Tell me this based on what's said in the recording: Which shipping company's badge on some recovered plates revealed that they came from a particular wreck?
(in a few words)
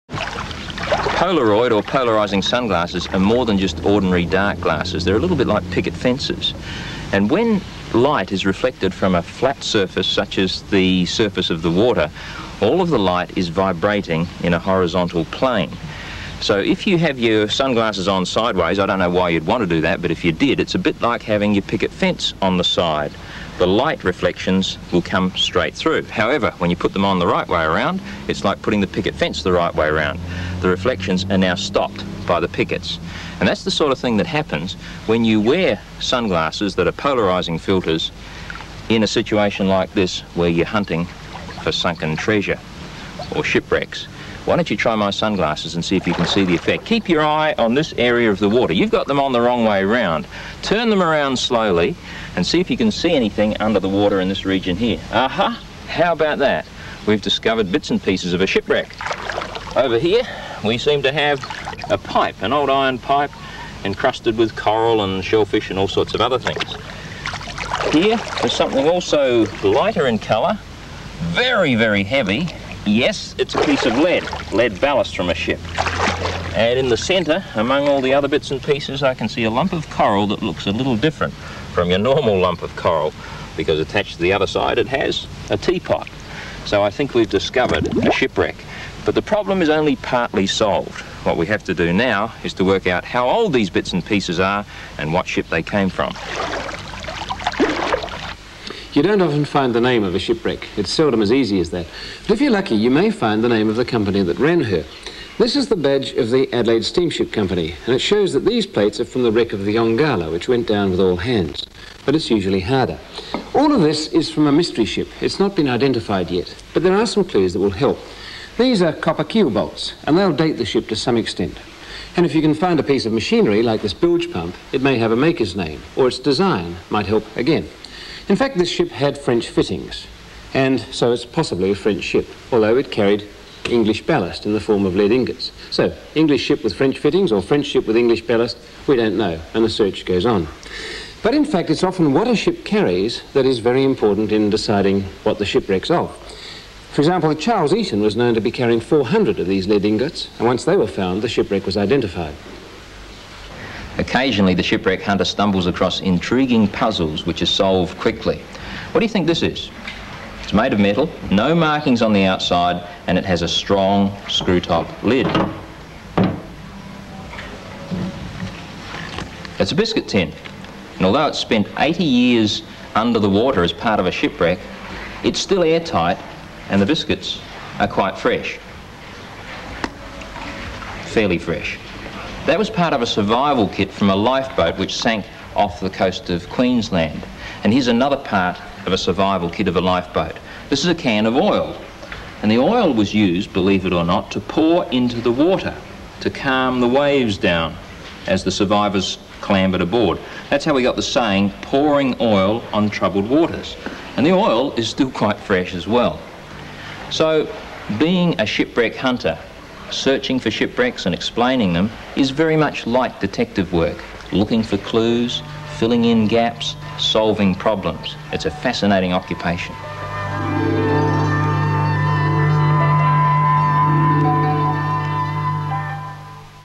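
Adelaide Steamship Company.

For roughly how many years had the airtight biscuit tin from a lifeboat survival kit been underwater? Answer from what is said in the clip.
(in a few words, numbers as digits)
80.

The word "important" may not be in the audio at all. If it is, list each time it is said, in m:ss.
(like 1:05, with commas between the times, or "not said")
2:23.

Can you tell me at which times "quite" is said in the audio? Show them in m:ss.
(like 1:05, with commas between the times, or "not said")
2:57, 3:25.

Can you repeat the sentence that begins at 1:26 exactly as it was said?
So I think we've discovered a shipwreck.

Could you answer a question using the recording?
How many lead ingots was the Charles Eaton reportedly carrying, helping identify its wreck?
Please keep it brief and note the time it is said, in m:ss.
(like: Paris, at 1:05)
400, at 2:28.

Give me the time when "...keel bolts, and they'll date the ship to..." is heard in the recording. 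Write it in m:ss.
1:59.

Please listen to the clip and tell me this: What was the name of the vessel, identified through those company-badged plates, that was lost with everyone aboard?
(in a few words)
Yongala.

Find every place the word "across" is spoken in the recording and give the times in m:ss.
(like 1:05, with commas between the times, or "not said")
2:35.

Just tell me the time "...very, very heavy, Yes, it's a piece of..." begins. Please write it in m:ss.
1:11.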